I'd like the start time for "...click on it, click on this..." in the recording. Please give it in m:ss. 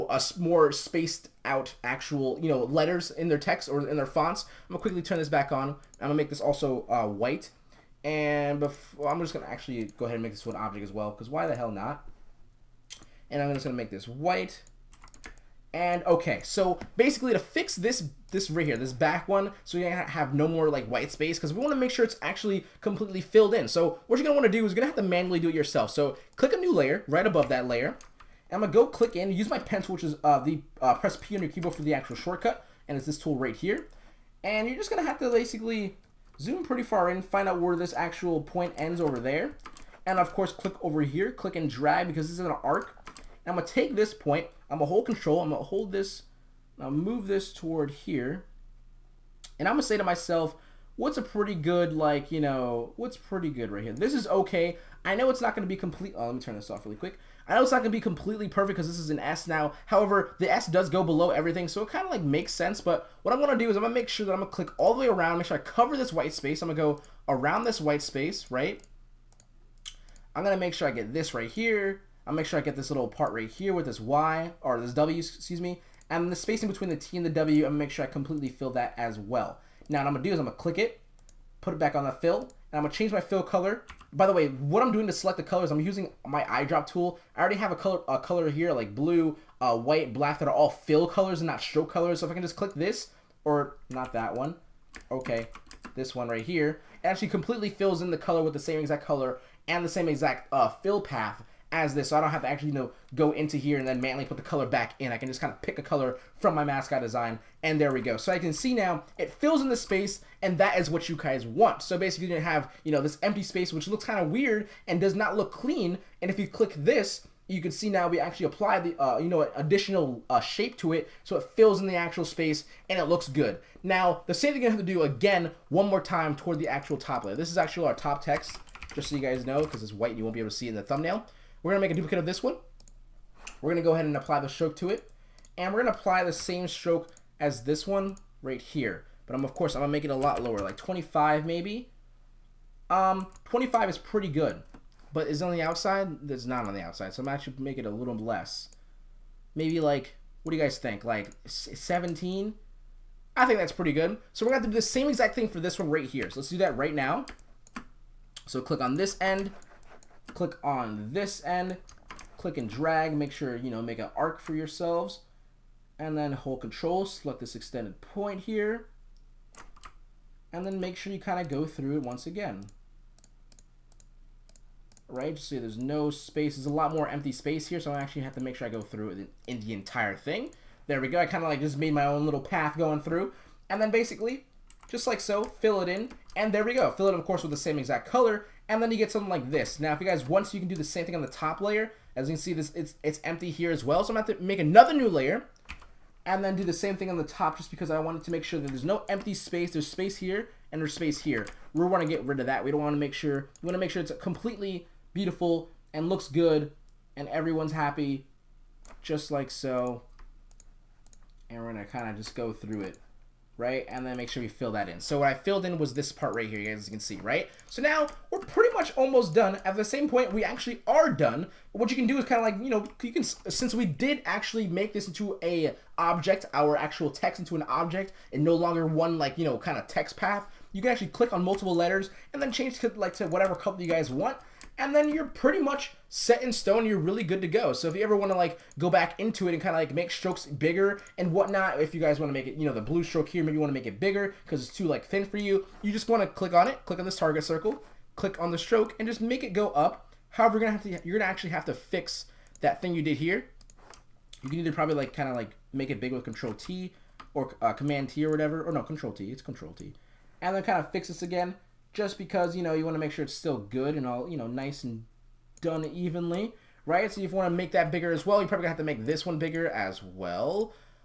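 4:06.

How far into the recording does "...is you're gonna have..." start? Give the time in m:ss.
0:24.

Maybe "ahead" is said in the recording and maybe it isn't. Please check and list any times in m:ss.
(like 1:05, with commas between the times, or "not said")
0:10, 2:13.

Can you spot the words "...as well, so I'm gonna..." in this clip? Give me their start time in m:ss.
3:13.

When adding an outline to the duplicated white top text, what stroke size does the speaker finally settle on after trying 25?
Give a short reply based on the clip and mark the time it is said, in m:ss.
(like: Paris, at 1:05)
17, at 2:31.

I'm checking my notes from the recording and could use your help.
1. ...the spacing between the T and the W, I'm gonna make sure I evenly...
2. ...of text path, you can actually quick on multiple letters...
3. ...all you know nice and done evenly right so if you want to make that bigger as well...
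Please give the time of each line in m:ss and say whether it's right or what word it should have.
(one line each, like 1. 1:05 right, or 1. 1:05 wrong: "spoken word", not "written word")
1. 1:16 wrong: "completely", not "evenly"
2. 3:49 wrong: "click", not "quick"
3. 4:24 right.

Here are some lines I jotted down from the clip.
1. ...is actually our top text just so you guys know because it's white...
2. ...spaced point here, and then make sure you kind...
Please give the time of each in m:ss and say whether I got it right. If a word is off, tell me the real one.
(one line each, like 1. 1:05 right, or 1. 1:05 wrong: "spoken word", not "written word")
1. 2:07 right
2. 2:47 wrong: "extended", not "spaced".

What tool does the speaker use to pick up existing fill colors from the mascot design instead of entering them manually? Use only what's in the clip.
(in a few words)
eyedrop tool.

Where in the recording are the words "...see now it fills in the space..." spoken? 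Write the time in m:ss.
1:48.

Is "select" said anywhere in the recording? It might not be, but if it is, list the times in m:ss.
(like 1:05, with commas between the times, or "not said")
1:25, 2:47.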